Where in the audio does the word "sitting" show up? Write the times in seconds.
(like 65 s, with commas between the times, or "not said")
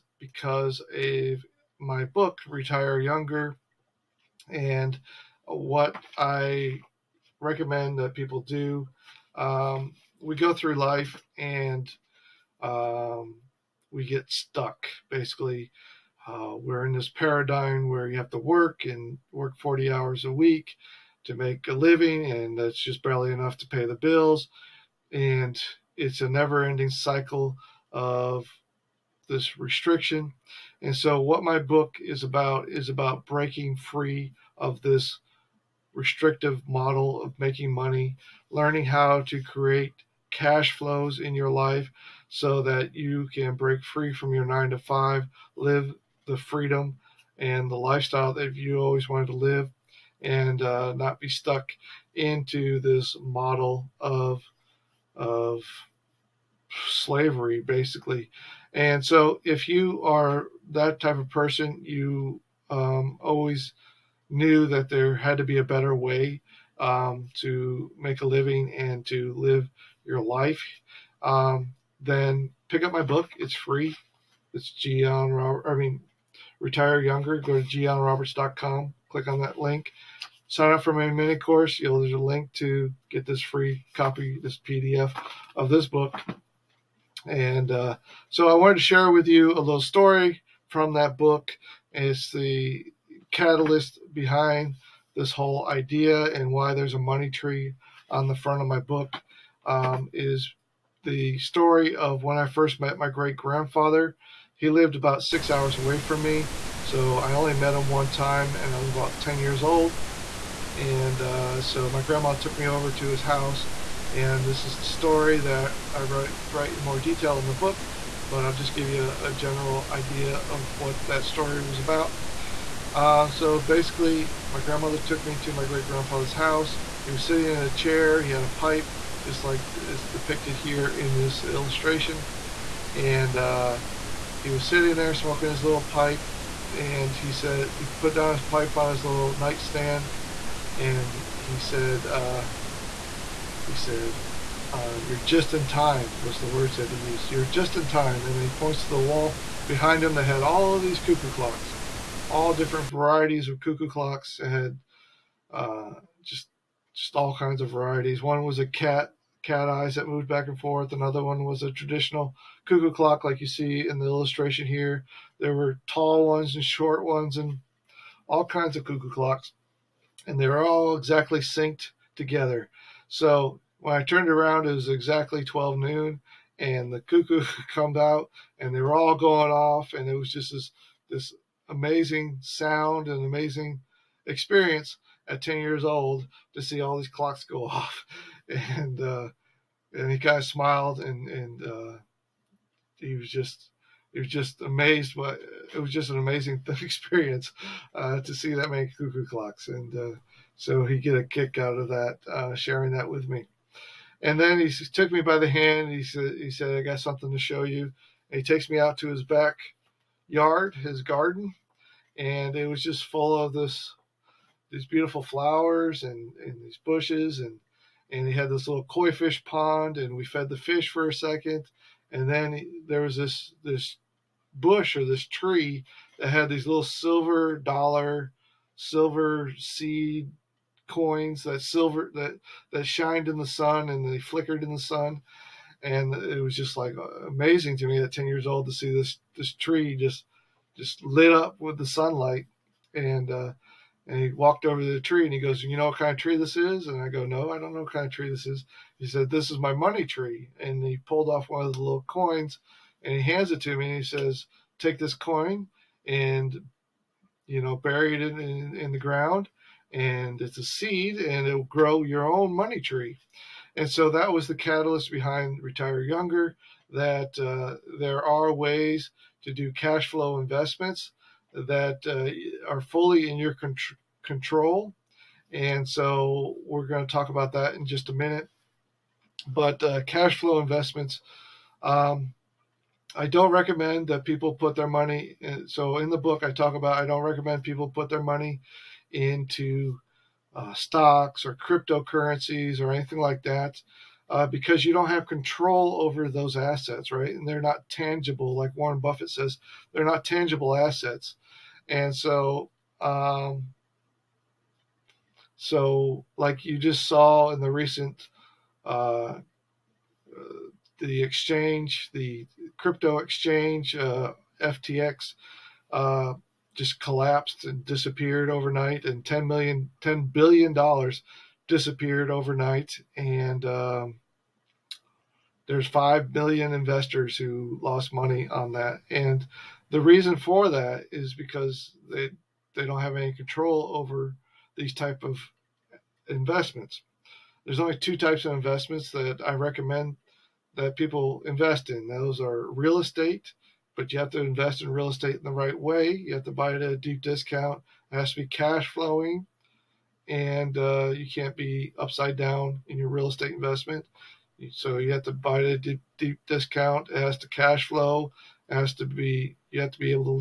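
127 s, 134 s.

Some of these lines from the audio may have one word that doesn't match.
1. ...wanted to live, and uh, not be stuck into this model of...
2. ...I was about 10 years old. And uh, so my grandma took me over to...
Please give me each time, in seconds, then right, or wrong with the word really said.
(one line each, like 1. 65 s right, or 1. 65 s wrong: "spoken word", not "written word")
1. 49 s right
2. 108 s right.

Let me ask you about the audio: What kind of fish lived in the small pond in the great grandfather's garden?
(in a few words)
Koi.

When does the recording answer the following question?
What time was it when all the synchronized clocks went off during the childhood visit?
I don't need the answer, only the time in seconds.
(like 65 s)
175 s.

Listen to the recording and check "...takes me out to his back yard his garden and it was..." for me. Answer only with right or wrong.
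right.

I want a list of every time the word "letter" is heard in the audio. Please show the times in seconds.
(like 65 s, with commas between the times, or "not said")
not said.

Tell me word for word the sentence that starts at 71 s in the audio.
Um, then pick up my book; it's free.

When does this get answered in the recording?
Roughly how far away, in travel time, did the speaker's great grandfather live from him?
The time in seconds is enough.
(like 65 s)
105 s.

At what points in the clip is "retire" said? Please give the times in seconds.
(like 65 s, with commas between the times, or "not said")
2 s, 76 s, 265 s.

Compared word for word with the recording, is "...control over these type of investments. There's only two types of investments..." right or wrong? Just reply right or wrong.
right.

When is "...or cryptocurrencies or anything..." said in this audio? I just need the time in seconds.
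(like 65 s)
291 s.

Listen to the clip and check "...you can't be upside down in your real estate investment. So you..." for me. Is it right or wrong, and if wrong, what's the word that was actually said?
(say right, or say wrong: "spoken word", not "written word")
right.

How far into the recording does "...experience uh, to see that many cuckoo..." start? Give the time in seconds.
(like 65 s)
196 s.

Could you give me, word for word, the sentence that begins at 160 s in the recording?
Another one was a traditional cuckoo clock, like you see in the illustration here.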